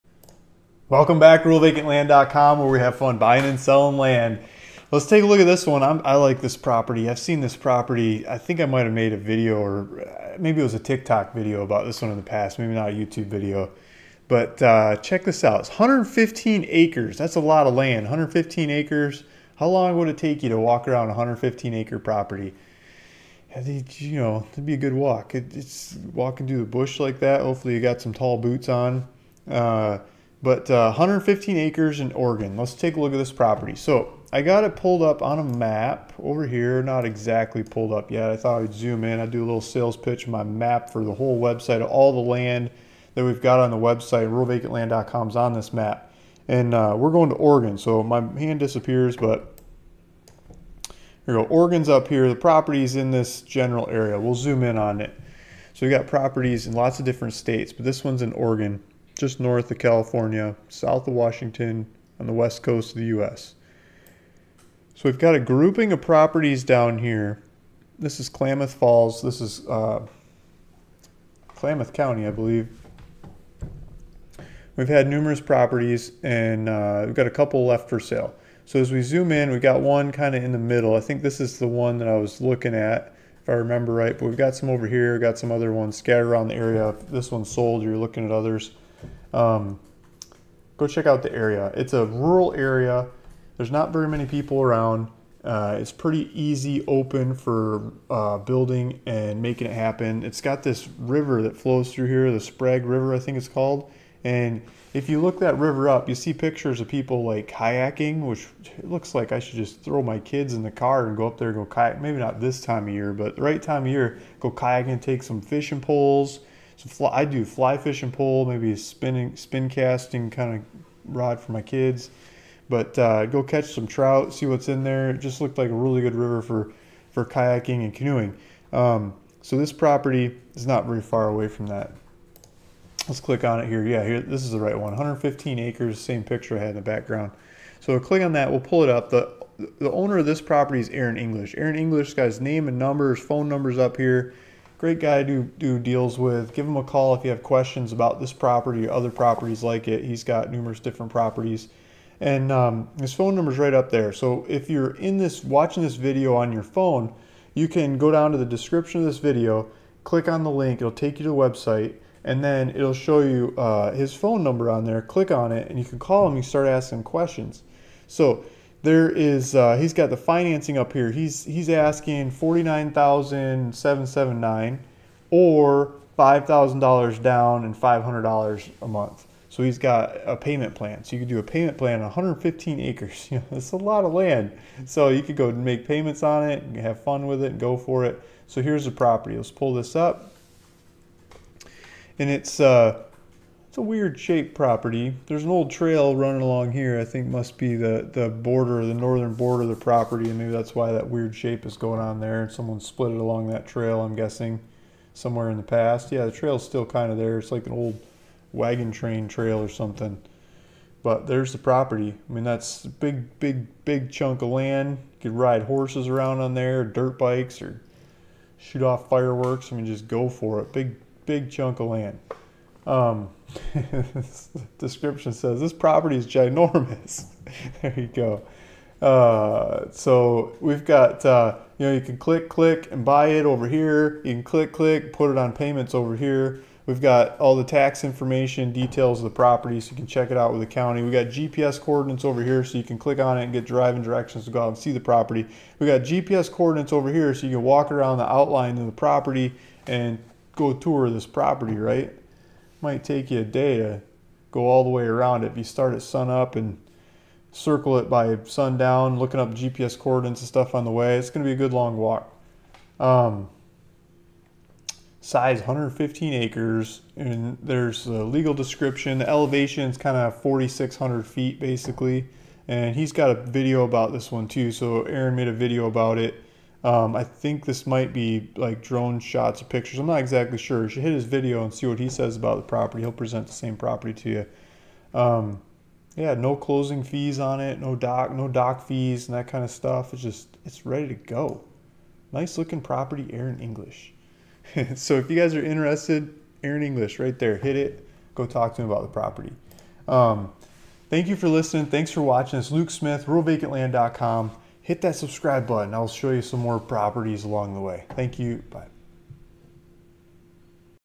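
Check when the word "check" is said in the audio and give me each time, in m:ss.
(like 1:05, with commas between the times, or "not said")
0:14, 1:30, 4:00.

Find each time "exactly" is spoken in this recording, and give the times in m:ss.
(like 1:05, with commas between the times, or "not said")
0:37, 4:40.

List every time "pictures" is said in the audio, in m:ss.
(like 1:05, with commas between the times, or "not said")
1:46, 2:16, 4:39.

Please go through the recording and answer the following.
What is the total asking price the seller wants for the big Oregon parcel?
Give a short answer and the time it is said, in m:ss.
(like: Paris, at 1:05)
$49,779, at 2:52.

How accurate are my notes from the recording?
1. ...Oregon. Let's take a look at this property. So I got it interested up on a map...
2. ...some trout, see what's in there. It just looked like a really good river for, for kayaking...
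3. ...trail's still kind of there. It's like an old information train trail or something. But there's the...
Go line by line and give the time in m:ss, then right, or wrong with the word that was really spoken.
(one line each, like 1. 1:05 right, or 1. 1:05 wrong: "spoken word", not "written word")
1. 0:32 wrong: "pulled", not "interested"
2. 2:03 right
3. 3:26 wrong: "wagon", not "information".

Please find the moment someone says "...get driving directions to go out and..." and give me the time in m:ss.
4:03.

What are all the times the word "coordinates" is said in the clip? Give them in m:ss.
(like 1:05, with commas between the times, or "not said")
4:01, 4:06, 4:19.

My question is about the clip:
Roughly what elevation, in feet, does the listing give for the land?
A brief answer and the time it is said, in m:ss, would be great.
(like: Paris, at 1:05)
4,600 feet, at 4:30.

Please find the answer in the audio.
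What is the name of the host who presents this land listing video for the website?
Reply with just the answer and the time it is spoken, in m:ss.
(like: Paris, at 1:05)
Luke Smith, at 5:02.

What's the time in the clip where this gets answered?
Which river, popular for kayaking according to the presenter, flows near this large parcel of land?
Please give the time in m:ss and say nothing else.
1:42.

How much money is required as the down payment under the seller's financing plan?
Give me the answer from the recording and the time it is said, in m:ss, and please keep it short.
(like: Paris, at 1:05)
$5,000, at 2:56.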